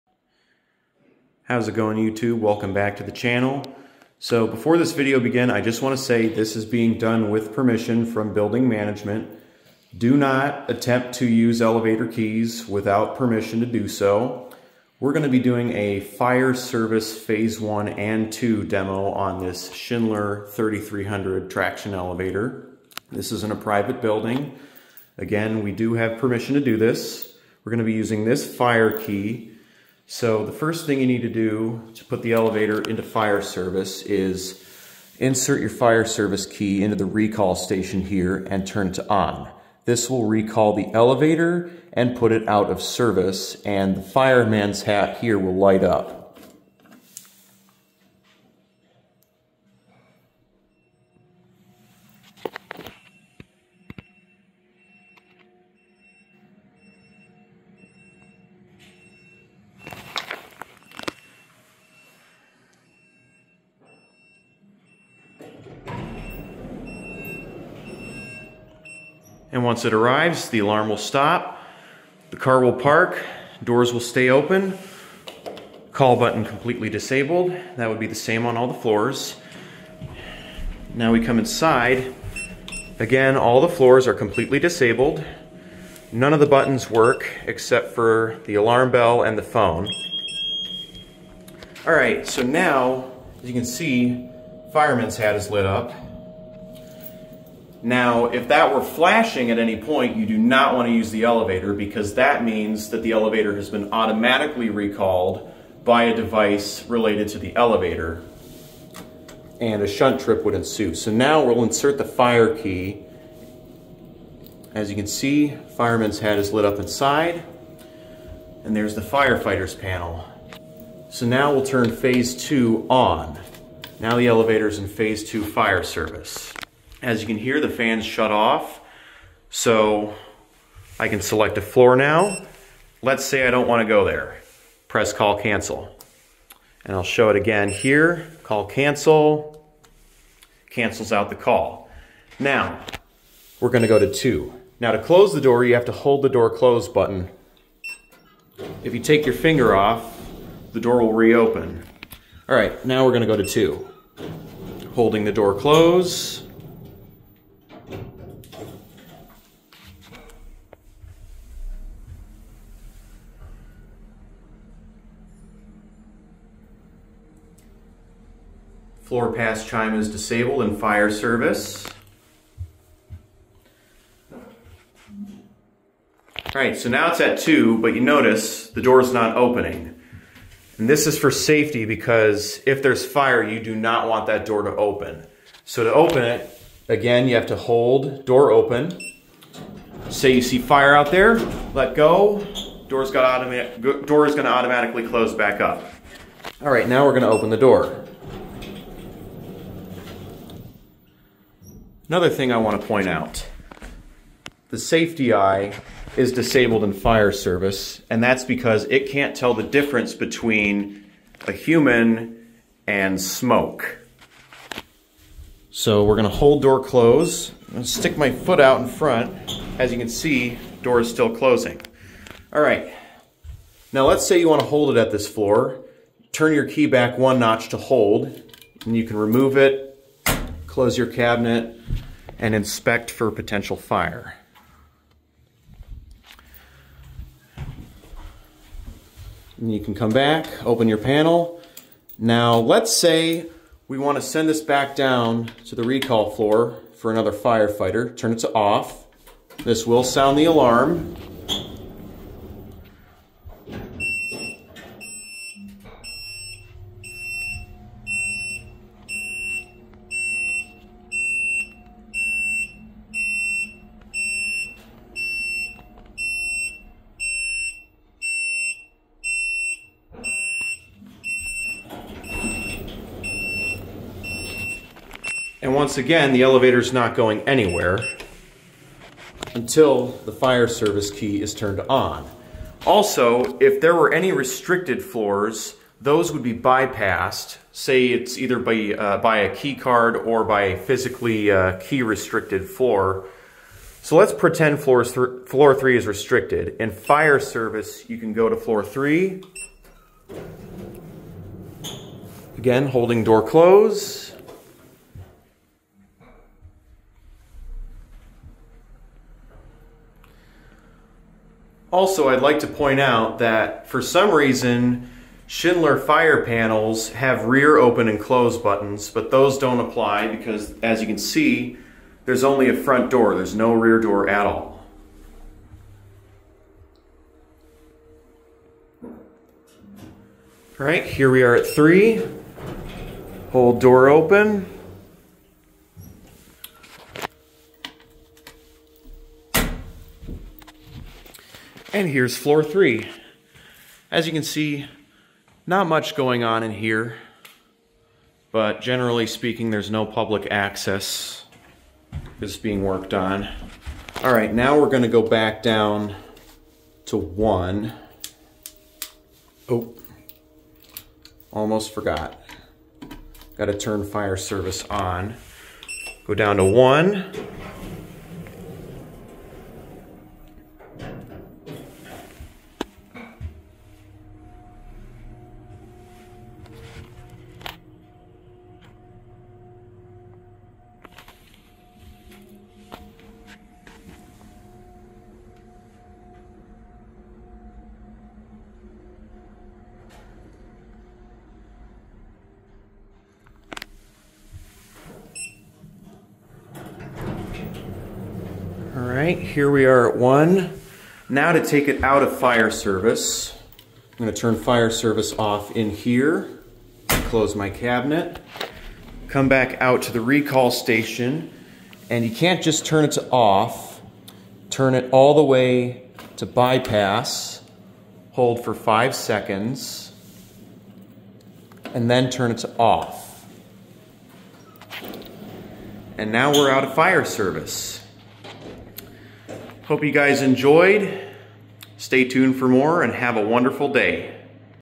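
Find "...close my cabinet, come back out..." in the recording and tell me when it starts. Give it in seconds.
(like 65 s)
407 s.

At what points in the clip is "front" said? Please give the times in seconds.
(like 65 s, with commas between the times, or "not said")
218 s, 322 s.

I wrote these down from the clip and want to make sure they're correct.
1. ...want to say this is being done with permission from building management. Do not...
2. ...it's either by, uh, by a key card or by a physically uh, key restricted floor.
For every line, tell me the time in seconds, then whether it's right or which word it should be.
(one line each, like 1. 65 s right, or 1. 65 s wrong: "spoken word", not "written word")
1. 5 s right
2. 288 s right.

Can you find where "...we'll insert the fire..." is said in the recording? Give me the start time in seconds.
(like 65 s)
111 s.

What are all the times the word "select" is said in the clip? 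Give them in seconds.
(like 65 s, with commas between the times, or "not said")
131 s.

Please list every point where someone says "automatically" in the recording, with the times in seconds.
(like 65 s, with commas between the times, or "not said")
103 s, 194 s.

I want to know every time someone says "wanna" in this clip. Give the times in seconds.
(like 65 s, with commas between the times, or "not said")
133 s, 224 s.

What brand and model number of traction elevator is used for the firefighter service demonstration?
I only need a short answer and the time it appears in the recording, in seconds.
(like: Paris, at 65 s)
Schindler 3300, at 19 s.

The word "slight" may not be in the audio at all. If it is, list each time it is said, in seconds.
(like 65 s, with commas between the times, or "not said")
not said.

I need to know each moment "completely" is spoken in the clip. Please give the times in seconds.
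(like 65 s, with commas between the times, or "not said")
76 s, 84 s.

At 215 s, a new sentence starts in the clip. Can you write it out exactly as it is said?
So we're gonna hold door closed.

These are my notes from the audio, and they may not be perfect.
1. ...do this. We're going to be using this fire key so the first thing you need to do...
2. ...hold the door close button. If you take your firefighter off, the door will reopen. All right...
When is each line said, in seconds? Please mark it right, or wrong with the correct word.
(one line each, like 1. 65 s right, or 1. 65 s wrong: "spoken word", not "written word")
1. 26 s right
2. 145 s wrong: "finger", not "firefighter".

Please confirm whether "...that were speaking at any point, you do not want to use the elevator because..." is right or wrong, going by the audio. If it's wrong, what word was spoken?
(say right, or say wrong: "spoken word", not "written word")
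wrong: "flashing", not "speaking".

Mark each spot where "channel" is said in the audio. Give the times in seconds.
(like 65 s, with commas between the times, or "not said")
3 s.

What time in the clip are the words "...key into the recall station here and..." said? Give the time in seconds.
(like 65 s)
36 s.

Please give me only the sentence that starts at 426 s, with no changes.
And now we're out of fire service.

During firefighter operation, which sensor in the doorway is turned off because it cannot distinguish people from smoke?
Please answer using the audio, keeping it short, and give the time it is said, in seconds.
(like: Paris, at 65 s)
safety eye, at 204 s.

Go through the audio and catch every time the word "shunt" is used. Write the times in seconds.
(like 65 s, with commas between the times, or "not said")
109 s.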